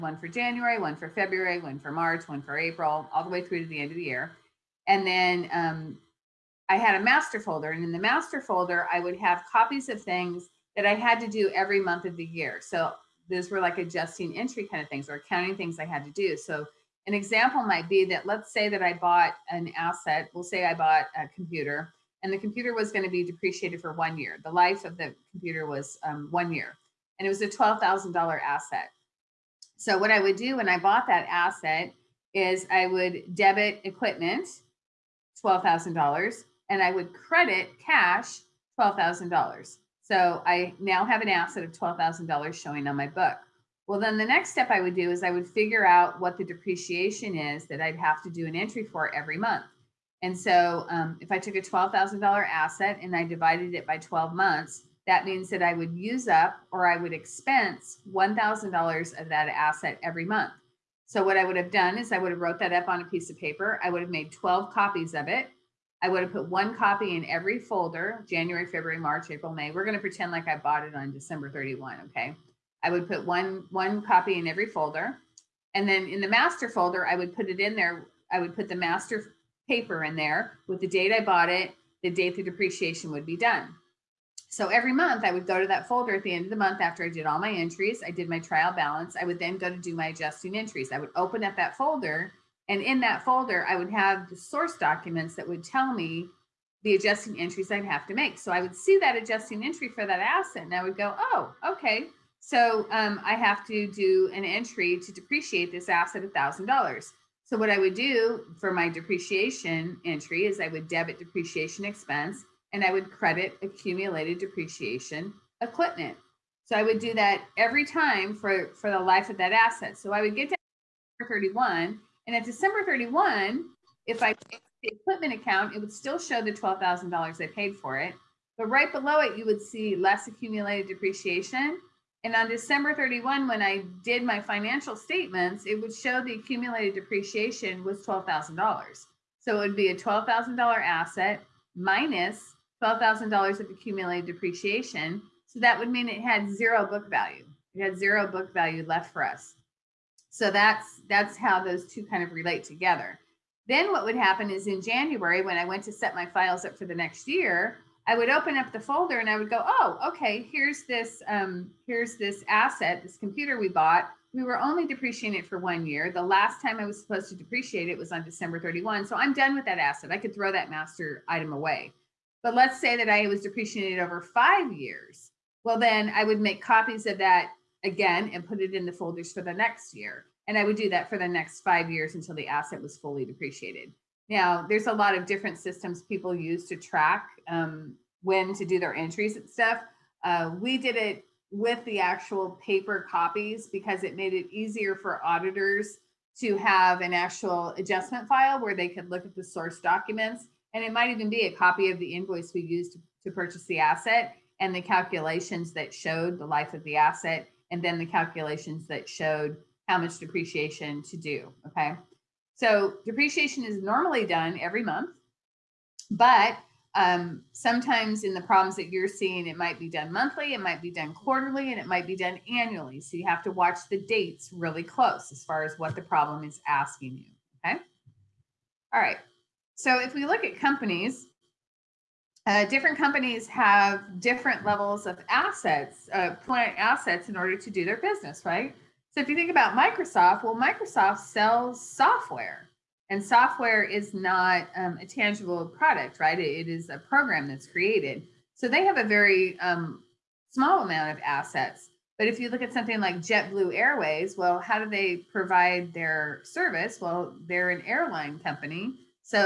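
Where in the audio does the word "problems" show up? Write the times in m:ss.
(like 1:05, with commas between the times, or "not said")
3:38, 3:46.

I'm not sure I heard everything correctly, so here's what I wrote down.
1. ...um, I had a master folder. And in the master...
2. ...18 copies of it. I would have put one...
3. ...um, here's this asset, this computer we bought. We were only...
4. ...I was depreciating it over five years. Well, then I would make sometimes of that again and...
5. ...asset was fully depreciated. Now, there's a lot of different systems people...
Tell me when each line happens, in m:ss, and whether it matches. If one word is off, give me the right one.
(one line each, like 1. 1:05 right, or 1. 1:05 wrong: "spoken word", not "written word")
1. 0:05 right
2. 1:04 wrong: "12", not "18"
3. 2:41 right
4. 2:53 wrong: "copies", not "sometimes"
5. 3:02 right.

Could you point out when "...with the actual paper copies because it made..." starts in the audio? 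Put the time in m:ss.
3:11.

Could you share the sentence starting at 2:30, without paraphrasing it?
So that's that's how those two kind of relate together.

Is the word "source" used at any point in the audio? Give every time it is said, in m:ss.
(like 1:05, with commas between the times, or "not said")
1:34, 3:19.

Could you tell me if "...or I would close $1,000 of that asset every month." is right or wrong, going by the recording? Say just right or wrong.
wrong.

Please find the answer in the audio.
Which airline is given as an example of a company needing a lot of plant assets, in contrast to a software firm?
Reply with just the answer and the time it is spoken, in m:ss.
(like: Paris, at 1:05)
JetBlue Airways, at 4:13.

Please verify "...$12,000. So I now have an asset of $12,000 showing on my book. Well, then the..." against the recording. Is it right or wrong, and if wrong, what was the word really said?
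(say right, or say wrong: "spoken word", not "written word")
right.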